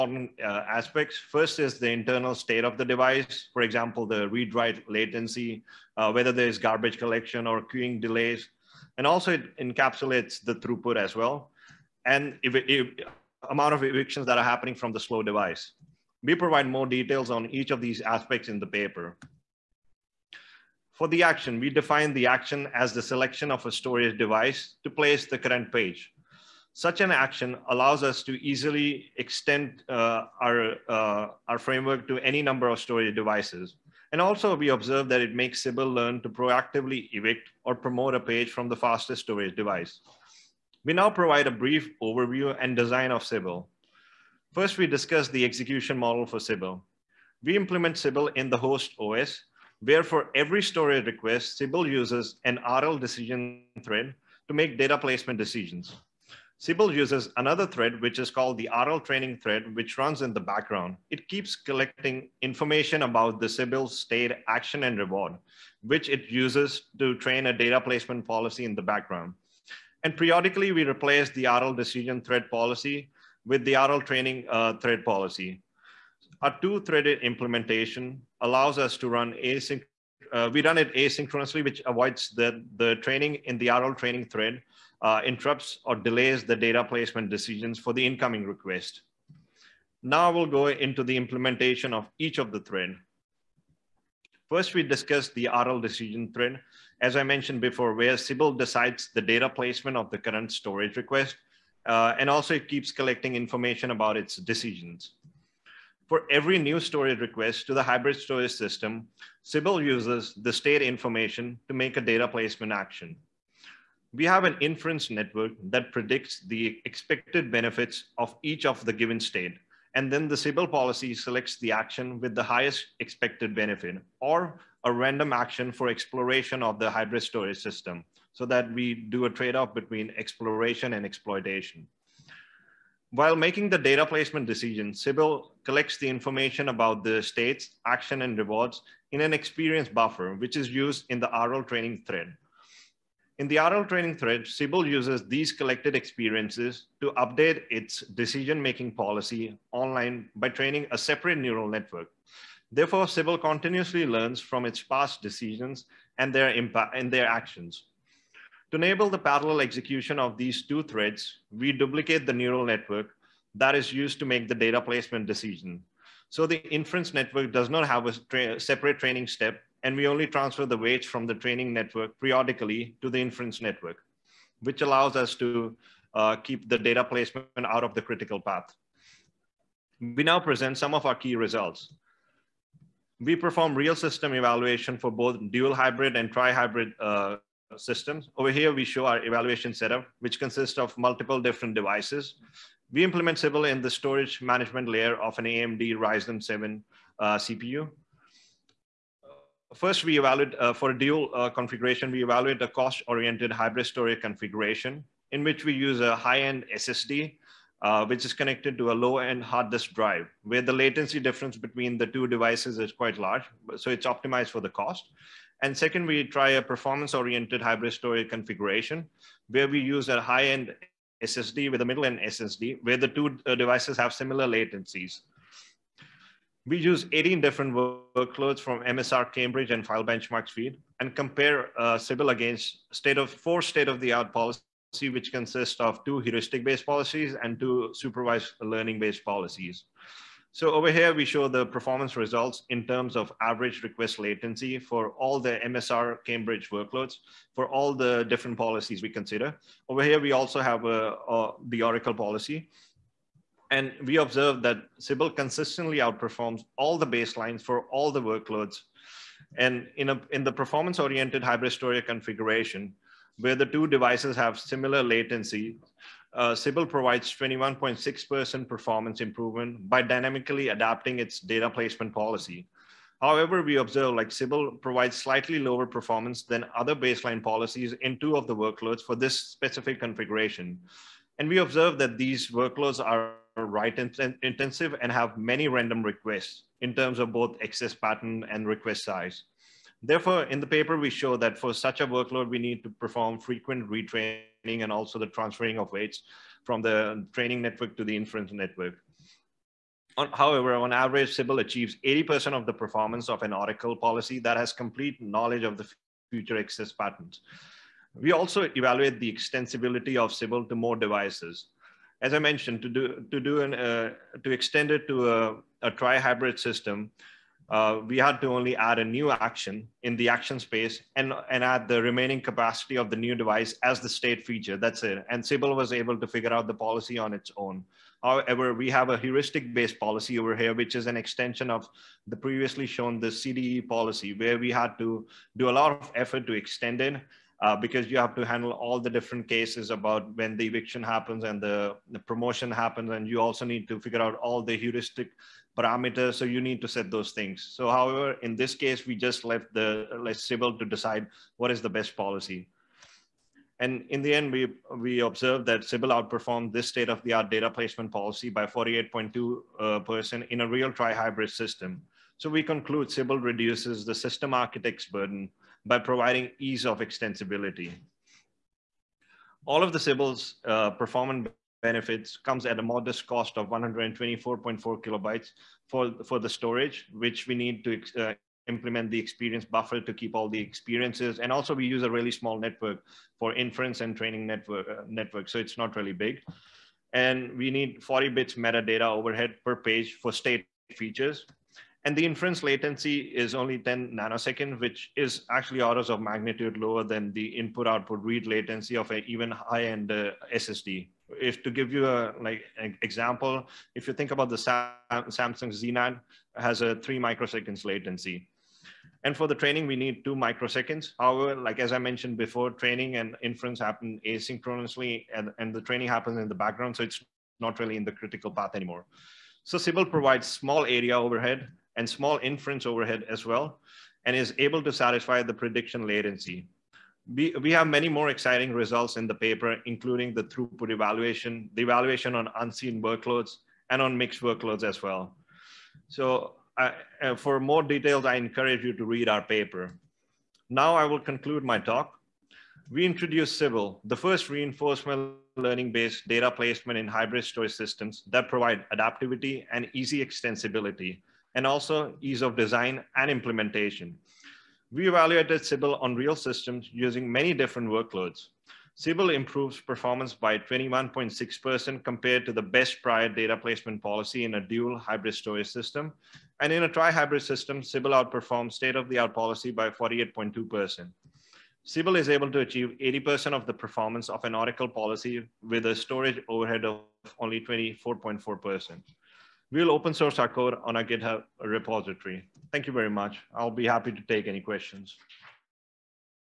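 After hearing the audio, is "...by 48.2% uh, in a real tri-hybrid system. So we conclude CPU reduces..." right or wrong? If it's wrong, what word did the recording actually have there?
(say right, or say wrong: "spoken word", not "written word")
wrong: "Sibyl", not "CPU".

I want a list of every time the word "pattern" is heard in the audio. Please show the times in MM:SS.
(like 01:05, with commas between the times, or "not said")
04:47, 05:06.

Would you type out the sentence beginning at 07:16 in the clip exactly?
So I, uh, for more details, I encourage you to read our paper.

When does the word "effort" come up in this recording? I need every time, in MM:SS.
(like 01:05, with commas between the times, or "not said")
05:36.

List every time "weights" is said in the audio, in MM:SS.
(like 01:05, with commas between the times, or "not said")
02:50, 04:55.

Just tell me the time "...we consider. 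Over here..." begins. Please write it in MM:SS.
04:09.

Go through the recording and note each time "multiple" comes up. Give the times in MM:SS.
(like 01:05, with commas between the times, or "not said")
03:10.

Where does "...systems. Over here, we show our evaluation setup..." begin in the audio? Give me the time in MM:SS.
03:07.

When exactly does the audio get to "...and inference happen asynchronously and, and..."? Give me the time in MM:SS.
06:53.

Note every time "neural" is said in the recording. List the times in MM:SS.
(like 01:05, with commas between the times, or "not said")
02:31, 02:42.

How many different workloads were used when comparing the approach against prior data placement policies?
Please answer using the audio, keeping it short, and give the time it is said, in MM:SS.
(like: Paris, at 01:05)
18, at 03:47.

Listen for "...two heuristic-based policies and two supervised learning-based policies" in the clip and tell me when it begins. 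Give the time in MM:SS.
03:56.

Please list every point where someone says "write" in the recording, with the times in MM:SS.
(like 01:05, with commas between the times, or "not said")
00:04, 04:43.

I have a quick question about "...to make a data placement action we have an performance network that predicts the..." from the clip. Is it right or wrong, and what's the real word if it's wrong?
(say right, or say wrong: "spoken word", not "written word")
wrong: "inference", not "performance".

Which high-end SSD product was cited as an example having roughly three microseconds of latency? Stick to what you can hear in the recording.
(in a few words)
Samsung Z-NAND.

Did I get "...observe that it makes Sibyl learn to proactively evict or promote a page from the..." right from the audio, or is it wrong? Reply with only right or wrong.
right.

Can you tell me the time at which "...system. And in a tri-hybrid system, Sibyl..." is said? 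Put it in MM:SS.
07:45.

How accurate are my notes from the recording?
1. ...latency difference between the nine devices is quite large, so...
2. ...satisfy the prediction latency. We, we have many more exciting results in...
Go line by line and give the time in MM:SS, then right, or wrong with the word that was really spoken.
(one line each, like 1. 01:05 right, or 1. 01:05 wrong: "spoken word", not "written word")
1. 03:30 wrong: "two", not "nine"
2. 07:04 right.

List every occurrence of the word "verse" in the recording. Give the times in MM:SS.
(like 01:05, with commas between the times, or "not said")
not said.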